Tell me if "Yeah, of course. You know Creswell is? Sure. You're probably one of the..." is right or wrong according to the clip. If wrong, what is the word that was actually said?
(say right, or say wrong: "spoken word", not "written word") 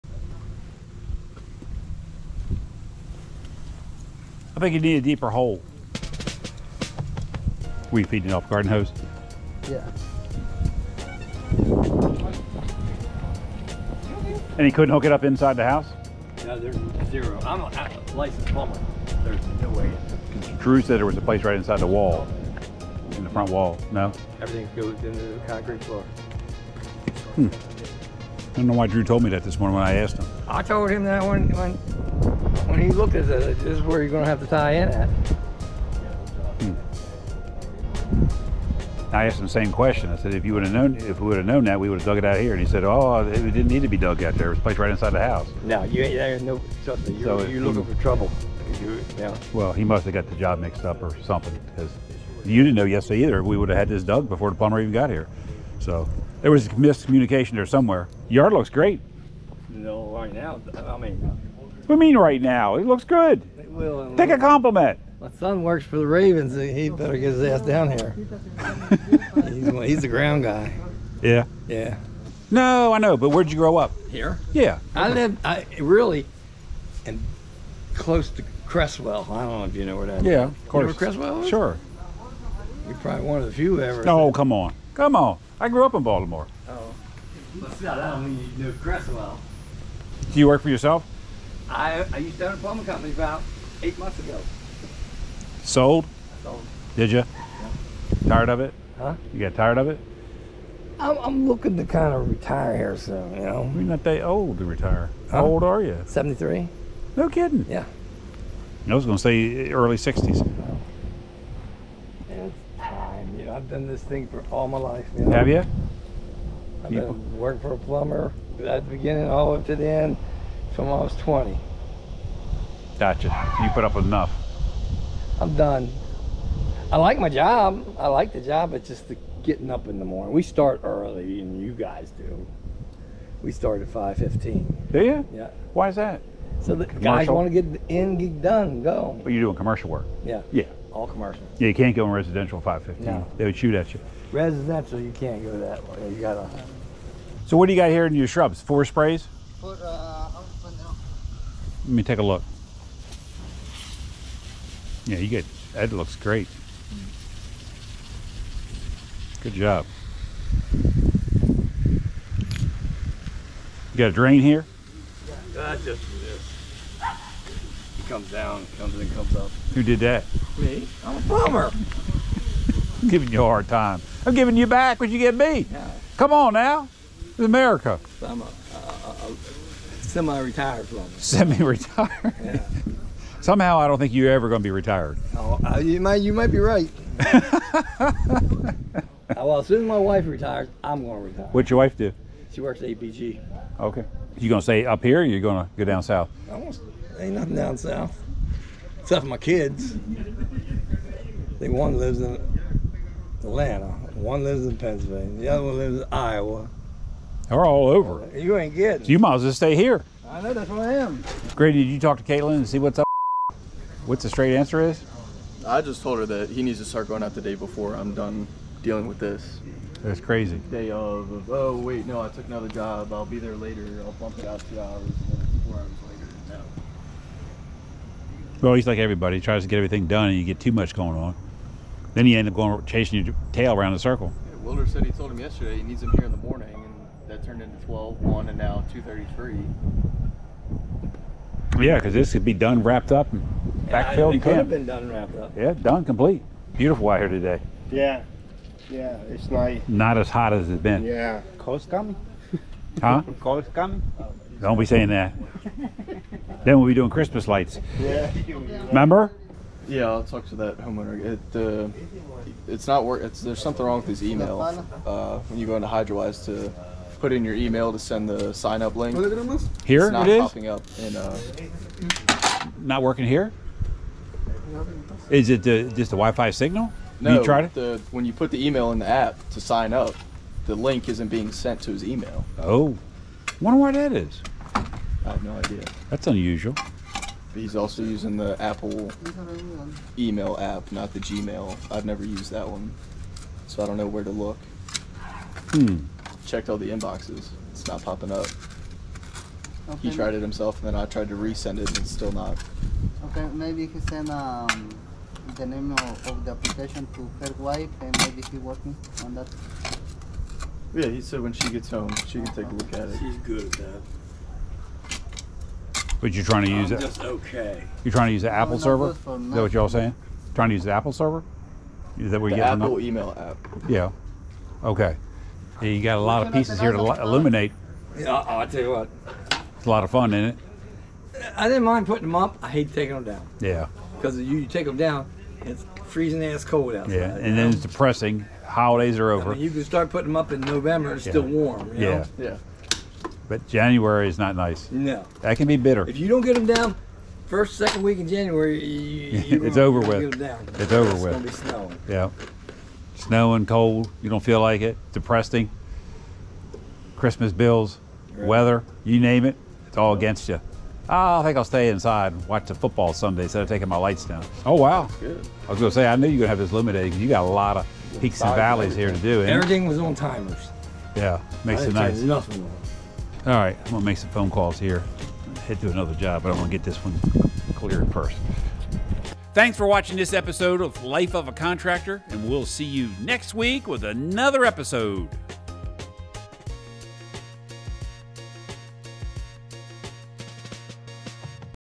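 right.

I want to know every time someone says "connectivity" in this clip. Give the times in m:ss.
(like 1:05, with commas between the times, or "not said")
not said.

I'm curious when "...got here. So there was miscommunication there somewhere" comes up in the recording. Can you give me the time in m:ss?
0:54.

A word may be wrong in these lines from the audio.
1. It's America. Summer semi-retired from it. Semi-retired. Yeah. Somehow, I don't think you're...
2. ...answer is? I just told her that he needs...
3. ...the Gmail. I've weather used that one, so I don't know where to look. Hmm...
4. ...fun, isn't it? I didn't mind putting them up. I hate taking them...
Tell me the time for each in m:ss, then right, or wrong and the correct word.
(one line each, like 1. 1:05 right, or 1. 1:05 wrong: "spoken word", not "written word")
1. 2:57 right
2. 3:34 right
3. 4:51 wrong: "never", not "weather"
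4. 5:30 right.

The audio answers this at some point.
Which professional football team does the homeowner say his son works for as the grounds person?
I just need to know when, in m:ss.
1:06.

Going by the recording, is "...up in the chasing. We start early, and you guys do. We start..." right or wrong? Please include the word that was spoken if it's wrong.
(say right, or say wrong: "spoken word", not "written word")
wrong: "morning", not "chasing".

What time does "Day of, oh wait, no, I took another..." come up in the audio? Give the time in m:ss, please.
3:40.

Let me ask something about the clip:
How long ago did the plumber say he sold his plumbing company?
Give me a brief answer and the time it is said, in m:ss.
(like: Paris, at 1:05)
8 months, at 1:33.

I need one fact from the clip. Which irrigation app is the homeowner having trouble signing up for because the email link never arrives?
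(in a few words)
Hydrawise.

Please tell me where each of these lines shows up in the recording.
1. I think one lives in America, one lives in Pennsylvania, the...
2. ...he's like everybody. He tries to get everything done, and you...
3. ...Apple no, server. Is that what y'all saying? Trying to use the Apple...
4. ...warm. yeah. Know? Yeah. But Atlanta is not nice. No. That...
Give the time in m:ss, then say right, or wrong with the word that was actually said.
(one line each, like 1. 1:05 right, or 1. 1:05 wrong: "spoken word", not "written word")
1. 3:19 wrong: "Atlanta", not "America"
2. 3:48 right
3. 5:18 right
4. 5:41 wrong: "January", not "Atlanta".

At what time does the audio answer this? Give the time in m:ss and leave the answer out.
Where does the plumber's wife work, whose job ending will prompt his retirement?
3:12.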